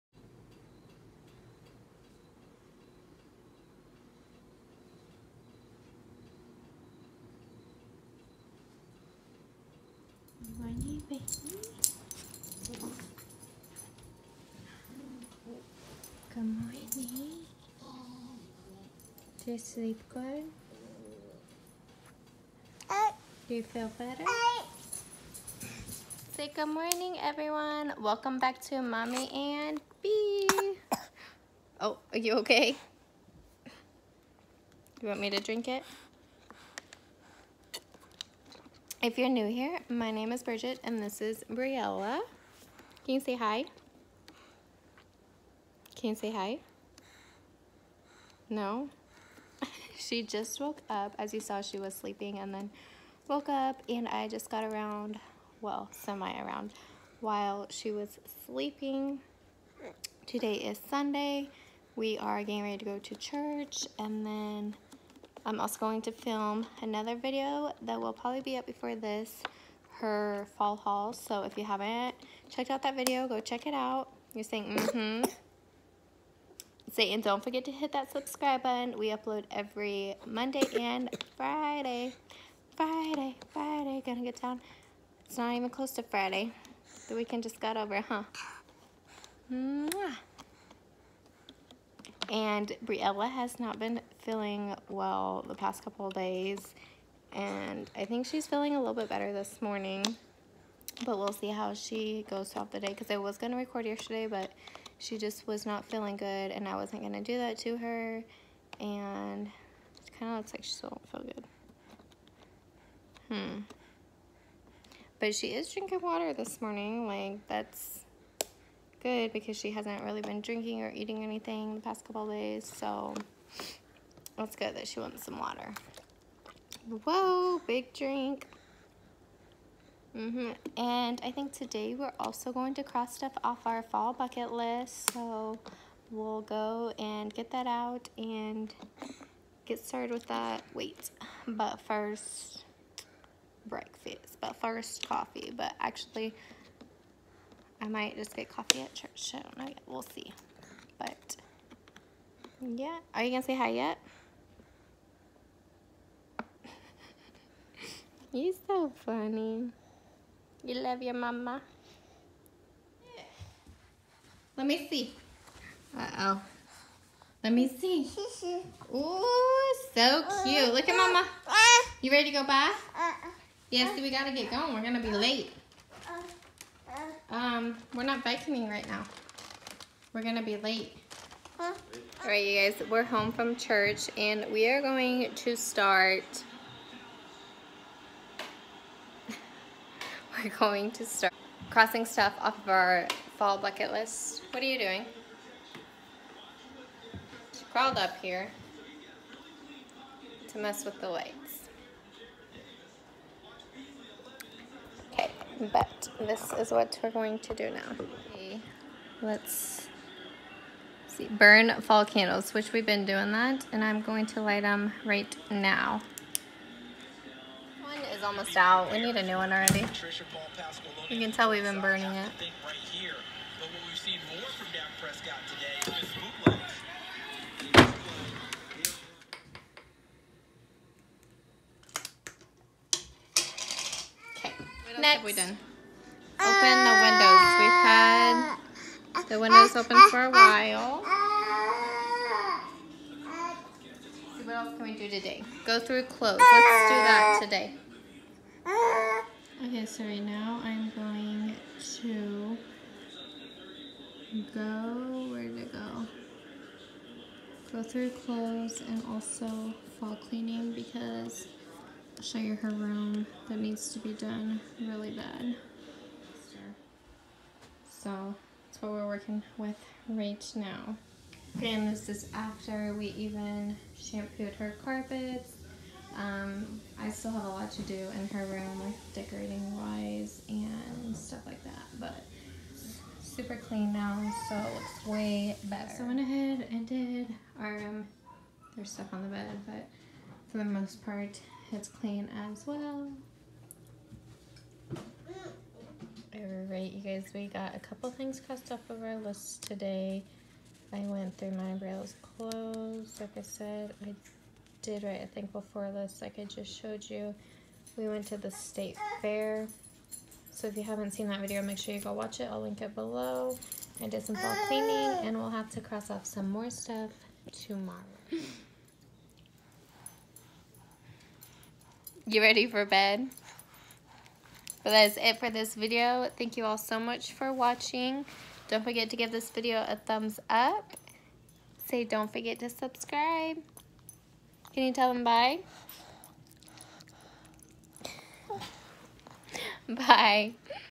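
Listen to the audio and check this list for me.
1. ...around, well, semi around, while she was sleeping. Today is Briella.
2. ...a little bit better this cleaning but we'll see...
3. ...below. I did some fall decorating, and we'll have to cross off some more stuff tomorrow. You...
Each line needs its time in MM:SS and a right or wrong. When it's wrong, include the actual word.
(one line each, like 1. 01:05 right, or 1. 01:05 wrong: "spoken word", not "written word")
1. 00:54 wrong: "Sunday", not "Briella"
2. 01:38 wrong: "morning", not "cleaning"
3. 05:12 wrong: "cleaning", not "decorating".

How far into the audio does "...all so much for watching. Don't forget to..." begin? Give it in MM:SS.
05:26.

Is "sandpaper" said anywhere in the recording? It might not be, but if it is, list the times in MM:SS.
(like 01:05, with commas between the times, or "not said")
not said.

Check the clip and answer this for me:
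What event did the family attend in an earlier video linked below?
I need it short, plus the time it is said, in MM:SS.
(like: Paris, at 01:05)
state fair, at 05:08.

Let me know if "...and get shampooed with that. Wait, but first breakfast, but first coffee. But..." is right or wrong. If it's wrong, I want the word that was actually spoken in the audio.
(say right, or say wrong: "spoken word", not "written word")
wrong: "started", not "shampooed".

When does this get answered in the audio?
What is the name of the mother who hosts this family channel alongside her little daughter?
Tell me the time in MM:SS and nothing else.
00:40.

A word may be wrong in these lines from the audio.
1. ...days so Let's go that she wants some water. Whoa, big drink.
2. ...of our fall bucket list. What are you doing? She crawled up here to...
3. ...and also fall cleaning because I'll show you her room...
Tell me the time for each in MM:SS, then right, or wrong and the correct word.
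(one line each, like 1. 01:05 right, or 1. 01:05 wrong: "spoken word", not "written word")
1. 02:02 right
2. 03:12 right
3. 04:18 right.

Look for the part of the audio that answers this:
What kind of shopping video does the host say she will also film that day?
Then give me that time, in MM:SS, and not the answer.
01:10.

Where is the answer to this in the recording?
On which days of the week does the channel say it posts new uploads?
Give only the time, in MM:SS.
01:20.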